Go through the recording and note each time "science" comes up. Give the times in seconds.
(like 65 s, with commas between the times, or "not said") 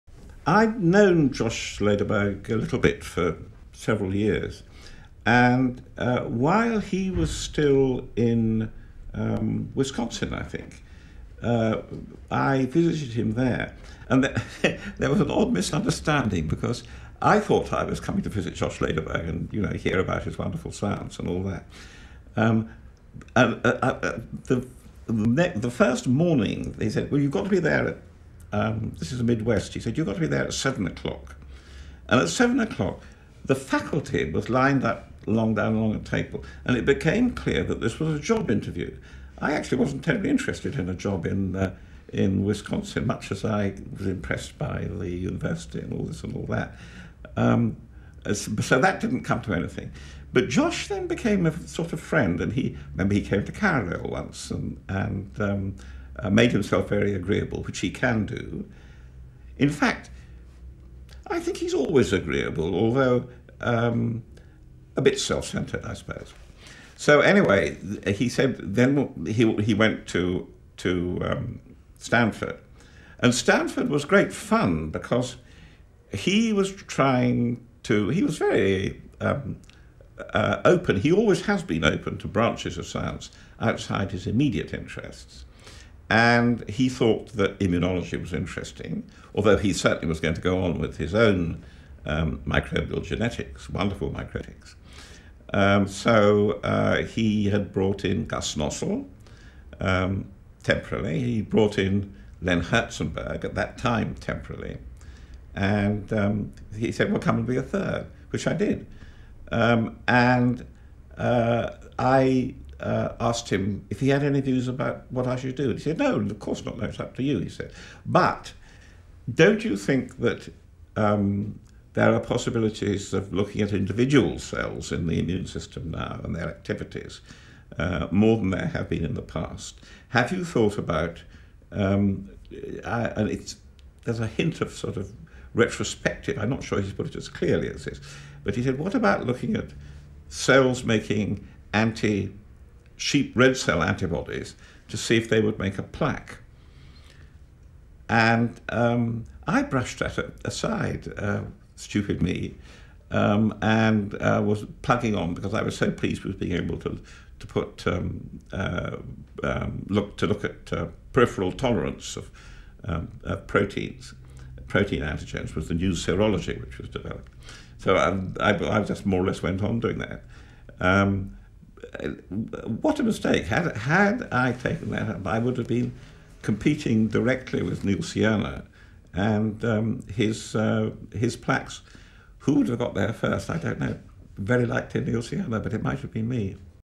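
20 s, 82 s.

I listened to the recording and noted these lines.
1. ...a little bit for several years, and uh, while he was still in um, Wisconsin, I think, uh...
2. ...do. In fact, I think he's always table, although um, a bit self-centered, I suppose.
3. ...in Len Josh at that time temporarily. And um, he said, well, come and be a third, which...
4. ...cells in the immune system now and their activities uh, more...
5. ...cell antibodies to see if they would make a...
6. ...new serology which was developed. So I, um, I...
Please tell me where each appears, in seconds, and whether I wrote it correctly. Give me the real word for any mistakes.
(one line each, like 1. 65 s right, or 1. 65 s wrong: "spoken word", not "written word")
1. 2 s right
2. 58 s wrong: "agreeable", not "table"
3. 101 s wrong: "Herzenberg", not "Josh"
4. 124 s right
5. 143 s right
6. 165 s right.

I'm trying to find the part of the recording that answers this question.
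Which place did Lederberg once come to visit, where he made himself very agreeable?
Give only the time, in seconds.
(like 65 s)
53 s.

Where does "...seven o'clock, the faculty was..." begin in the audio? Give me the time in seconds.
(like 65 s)
32 s.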